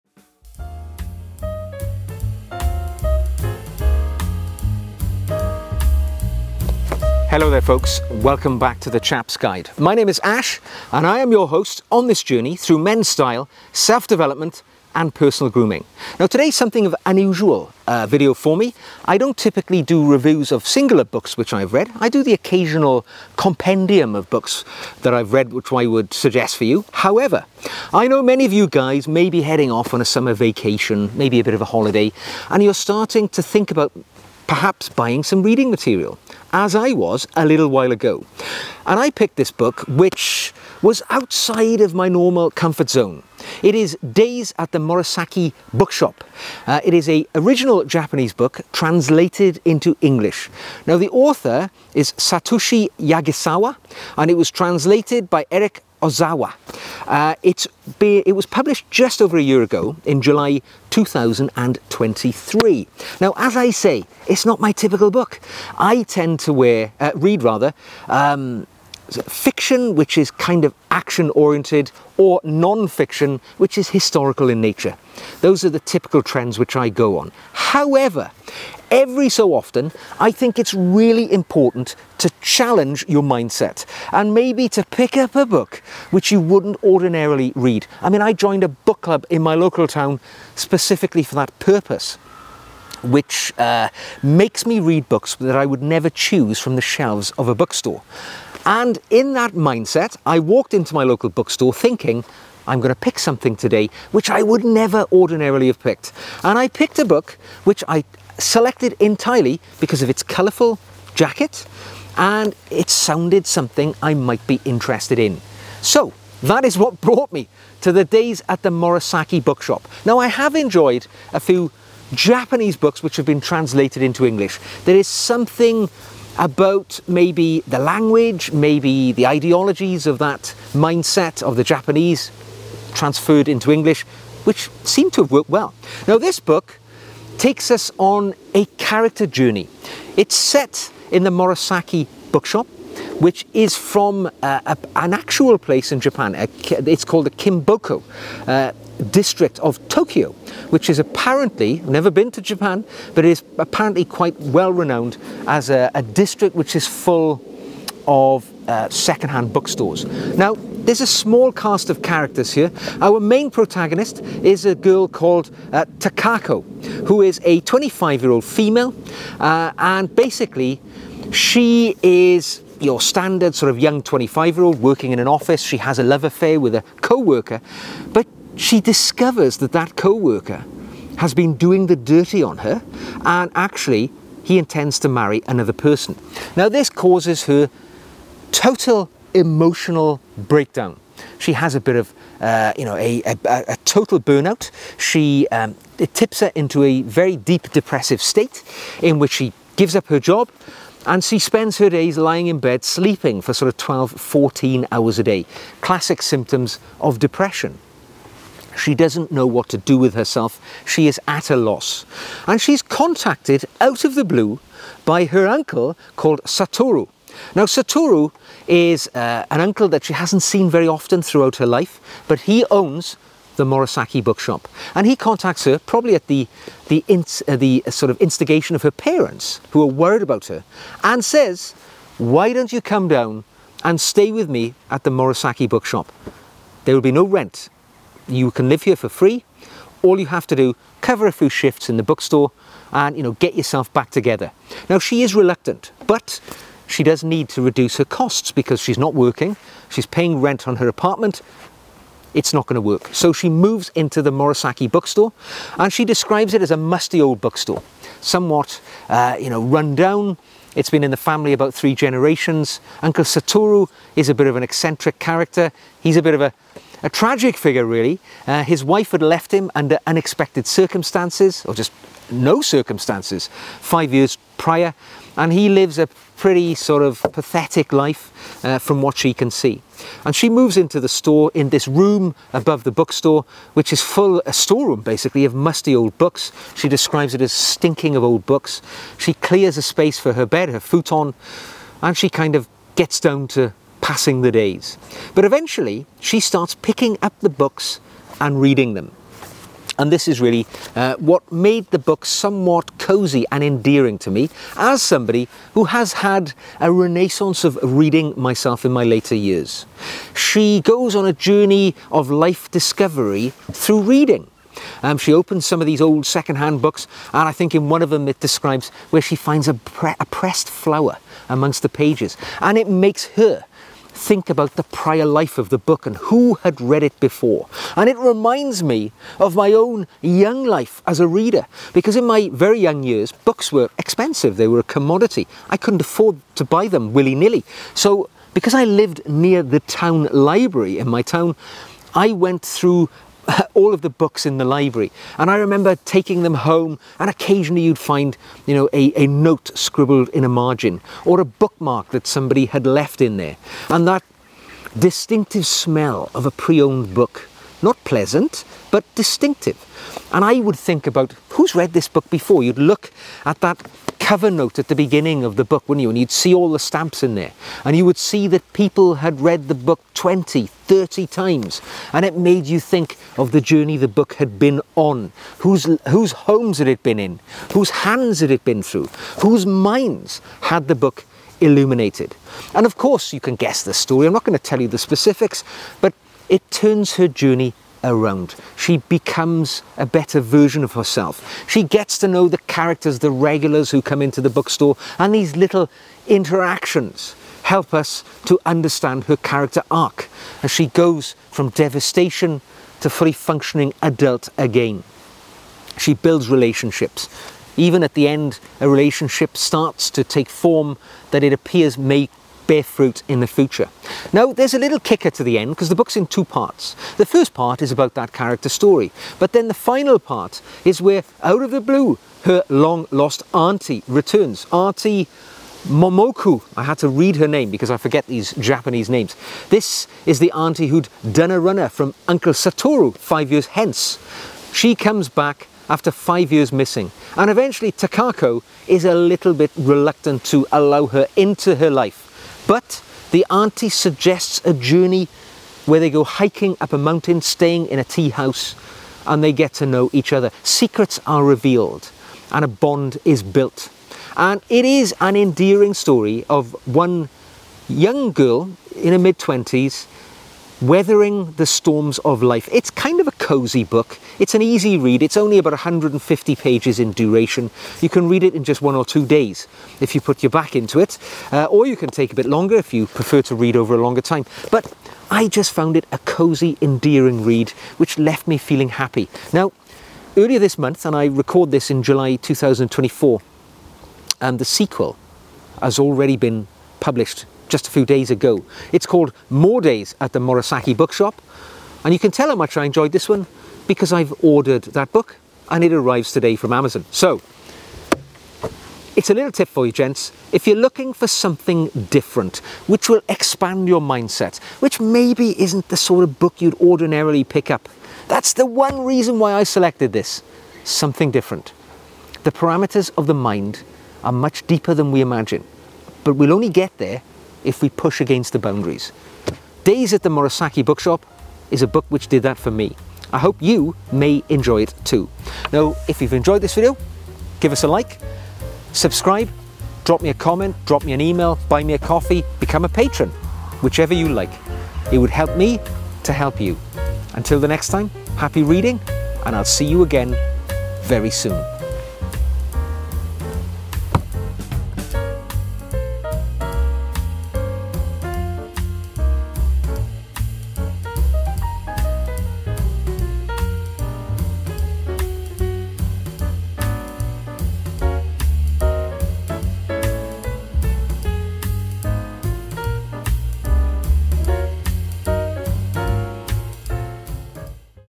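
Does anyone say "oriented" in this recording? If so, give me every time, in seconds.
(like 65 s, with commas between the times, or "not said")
71 s.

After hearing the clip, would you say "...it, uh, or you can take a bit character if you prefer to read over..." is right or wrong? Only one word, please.
wrong.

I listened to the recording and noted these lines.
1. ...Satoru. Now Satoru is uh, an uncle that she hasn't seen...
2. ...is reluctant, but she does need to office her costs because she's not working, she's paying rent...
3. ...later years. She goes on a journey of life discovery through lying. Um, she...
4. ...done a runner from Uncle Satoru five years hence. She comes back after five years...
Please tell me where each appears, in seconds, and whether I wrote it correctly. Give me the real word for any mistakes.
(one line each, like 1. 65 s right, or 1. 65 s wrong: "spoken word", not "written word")
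1. 216 s right
2. 245 s wrong: "reduce", not "office"
3. 309 s wrong: "reading", not "lying"
4. 431 s right.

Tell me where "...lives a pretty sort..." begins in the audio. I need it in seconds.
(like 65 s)
275 s.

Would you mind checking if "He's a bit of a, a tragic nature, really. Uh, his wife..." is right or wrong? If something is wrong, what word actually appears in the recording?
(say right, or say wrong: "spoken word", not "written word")
wrong: "figure", not "nature".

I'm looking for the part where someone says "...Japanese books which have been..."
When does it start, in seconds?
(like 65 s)
122 s.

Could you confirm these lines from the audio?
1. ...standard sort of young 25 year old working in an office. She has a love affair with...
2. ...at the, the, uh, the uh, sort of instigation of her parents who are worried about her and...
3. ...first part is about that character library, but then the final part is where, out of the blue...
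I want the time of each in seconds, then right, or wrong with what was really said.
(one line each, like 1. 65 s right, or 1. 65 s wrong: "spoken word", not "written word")
1. 172 s right
2. 226 s right
3. 417 s wrong: "story", not "library".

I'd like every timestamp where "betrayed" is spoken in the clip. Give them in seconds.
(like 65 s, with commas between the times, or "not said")
not said.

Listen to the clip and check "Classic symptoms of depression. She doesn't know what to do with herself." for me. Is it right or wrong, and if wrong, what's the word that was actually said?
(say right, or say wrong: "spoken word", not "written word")
right.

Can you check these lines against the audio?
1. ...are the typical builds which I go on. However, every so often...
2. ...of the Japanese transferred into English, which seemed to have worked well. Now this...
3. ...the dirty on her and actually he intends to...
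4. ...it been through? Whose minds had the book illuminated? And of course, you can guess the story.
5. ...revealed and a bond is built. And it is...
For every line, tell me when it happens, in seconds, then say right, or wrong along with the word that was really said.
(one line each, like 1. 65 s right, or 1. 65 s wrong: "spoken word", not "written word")
1. 75 s wrong: "trends", not "builds"
2. 131 s right
3. 181 s right
4. 378 s right
5. 451 s right.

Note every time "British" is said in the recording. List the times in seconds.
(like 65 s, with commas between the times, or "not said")
not said.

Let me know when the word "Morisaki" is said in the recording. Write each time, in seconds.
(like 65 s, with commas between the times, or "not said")
44 s, 118 s, 141 s, 223 s, 235 s, 254 s, 490 s, 520 s.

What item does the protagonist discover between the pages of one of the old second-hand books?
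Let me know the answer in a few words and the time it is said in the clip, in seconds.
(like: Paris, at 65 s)
a pressed flower, at 320 s.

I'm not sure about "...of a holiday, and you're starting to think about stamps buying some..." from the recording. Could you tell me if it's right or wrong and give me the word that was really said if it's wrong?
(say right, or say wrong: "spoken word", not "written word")
wrong: "perhaps", not "stamps".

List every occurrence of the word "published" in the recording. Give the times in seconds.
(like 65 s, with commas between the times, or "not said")
58 s, 487 s.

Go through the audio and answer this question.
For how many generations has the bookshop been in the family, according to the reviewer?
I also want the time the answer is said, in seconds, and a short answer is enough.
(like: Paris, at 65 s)
3, at 261 s.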